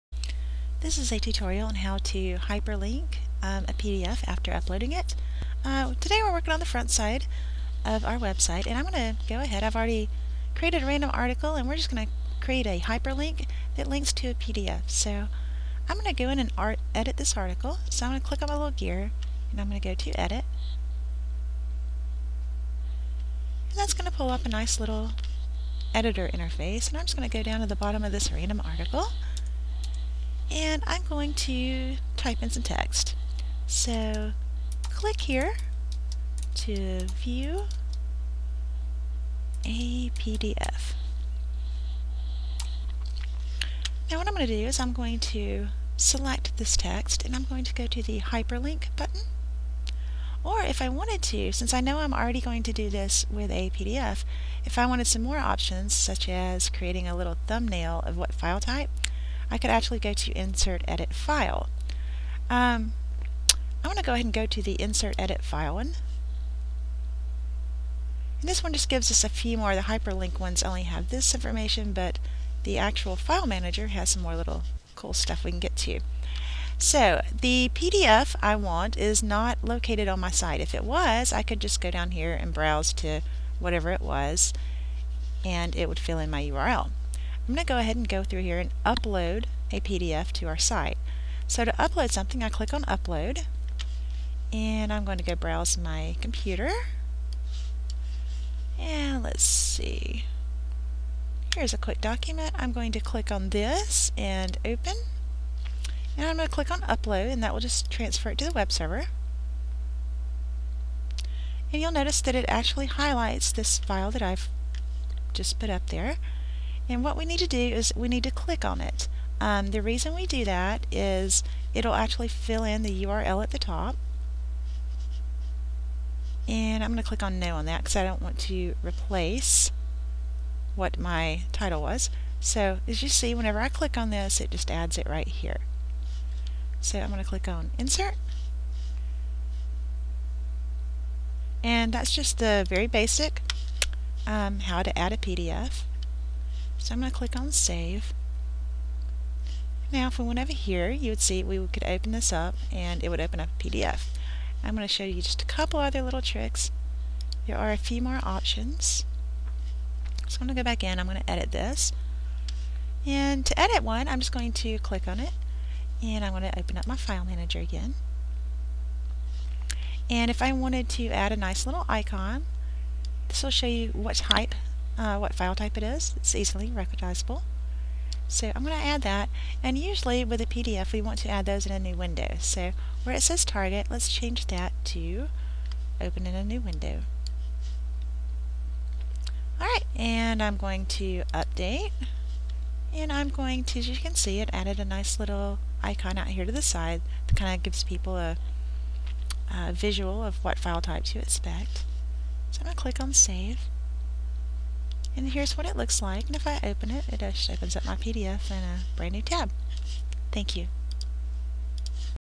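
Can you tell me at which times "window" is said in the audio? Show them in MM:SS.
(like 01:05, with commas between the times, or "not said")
03:01, 03:06.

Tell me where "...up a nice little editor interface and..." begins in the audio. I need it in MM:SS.
00:24.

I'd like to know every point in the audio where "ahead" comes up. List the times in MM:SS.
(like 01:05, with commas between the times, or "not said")
00:09, 01:04, 01:27.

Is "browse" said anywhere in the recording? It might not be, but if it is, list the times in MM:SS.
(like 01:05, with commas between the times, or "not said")
01:22, 01:35.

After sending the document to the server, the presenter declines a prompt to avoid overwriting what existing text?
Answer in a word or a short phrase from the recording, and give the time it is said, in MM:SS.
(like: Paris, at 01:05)
My title, at 02:10.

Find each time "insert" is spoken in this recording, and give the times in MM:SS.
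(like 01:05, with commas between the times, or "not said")
01:00, 01:04, 02:17.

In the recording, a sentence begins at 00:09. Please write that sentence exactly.
I've already created a random article and we're just going to create a hyperlink that links to a PDF.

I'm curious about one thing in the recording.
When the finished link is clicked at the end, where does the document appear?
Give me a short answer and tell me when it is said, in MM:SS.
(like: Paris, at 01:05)
A brand new tab, at 03:28.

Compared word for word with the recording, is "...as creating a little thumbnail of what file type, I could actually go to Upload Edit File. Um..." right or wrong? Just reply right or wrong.
wrong.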